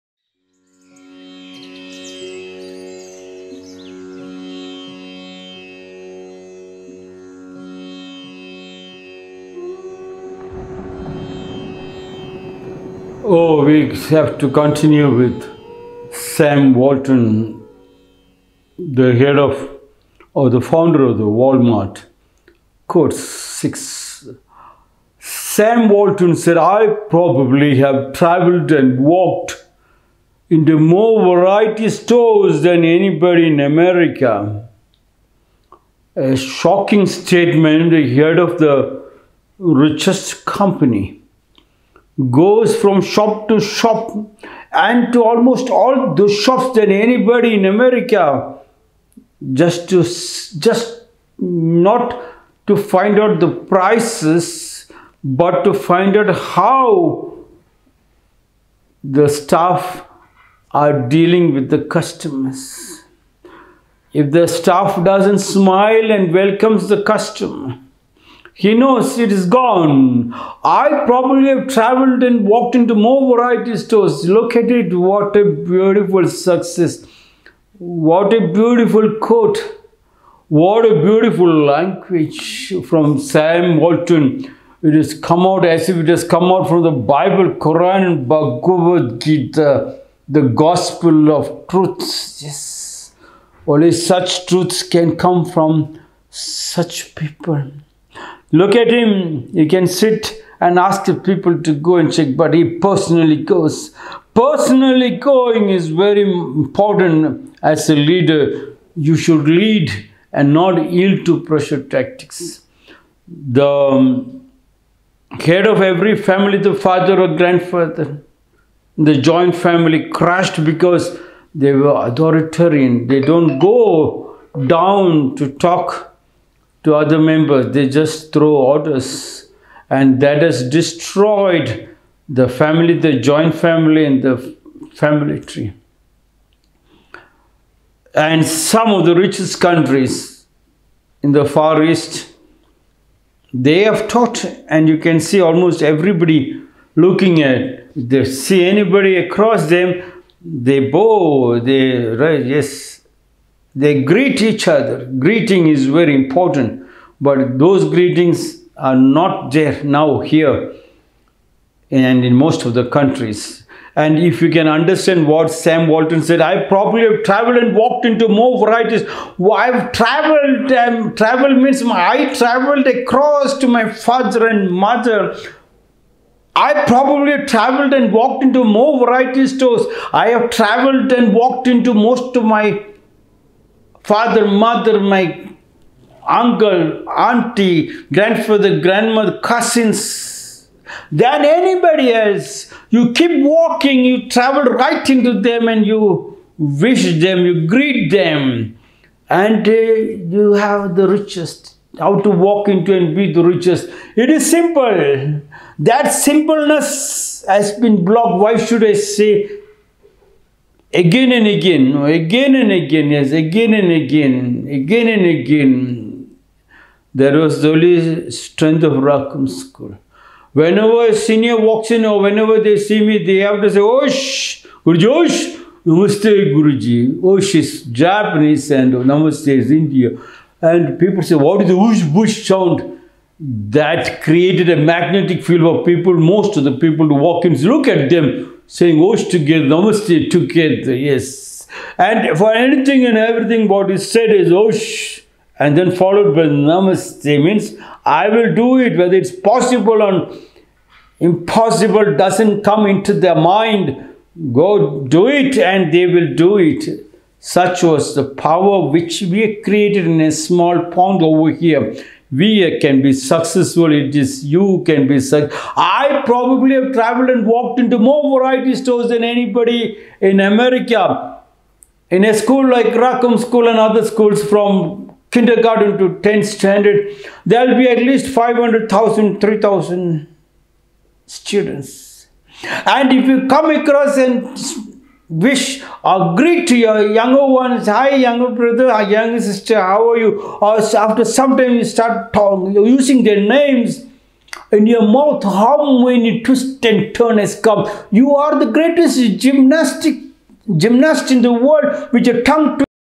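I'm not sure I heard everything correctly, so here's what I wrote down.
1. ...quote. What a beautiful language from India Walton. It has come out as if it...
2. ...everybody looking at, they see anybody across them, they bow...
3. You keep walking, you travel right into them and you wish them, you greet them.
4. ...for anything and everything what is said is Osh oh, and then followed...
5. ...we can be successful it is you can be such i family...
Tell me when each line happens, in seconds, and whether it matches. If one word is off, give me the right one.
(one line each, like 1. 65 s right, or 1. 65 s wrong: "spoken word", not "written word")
1. 79 s wrong: "Sam", not "India"
2. 145 s right
3. 192 s right
4. 242 s right
5. 262 s wrong: "probably", not "family".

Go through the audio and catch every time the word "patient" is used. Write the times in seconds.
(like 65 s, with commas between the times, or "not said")
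not said.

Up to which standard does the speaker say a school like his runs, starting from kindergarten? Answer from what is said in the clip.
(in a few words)
10th standard.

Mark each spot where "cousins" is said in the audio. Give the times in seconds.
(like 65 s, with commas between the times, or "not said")
189 s.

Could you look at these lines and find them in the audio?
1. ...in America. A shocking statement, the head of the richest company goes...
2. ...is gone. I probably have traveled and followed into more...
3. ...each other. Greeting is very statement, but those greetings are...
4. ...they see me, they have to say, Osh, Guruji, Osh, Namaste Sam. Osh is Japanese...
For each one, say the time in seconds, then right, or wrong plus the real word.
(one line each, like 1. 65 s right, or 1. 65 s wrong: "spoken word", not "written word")
1. 33 s right
2. 69 s wrong: "walked", not "followed"
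3. 154 s wrong: "important", not "statement"
4. 222 s wrong: "Guruji", not "Sam".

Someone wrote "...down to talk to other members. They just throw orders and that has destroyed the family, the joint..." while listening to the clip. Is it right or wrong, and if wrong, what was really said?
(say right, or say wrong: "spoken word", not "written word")
right.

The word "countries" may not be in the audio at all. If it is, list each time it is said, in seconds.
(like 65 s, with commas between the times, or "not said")
139 s, 162 s.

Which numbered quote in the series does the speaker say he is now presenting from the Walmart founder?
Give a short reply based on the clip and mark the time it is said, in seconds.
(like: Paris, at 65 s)
Quote 6, at 22 s.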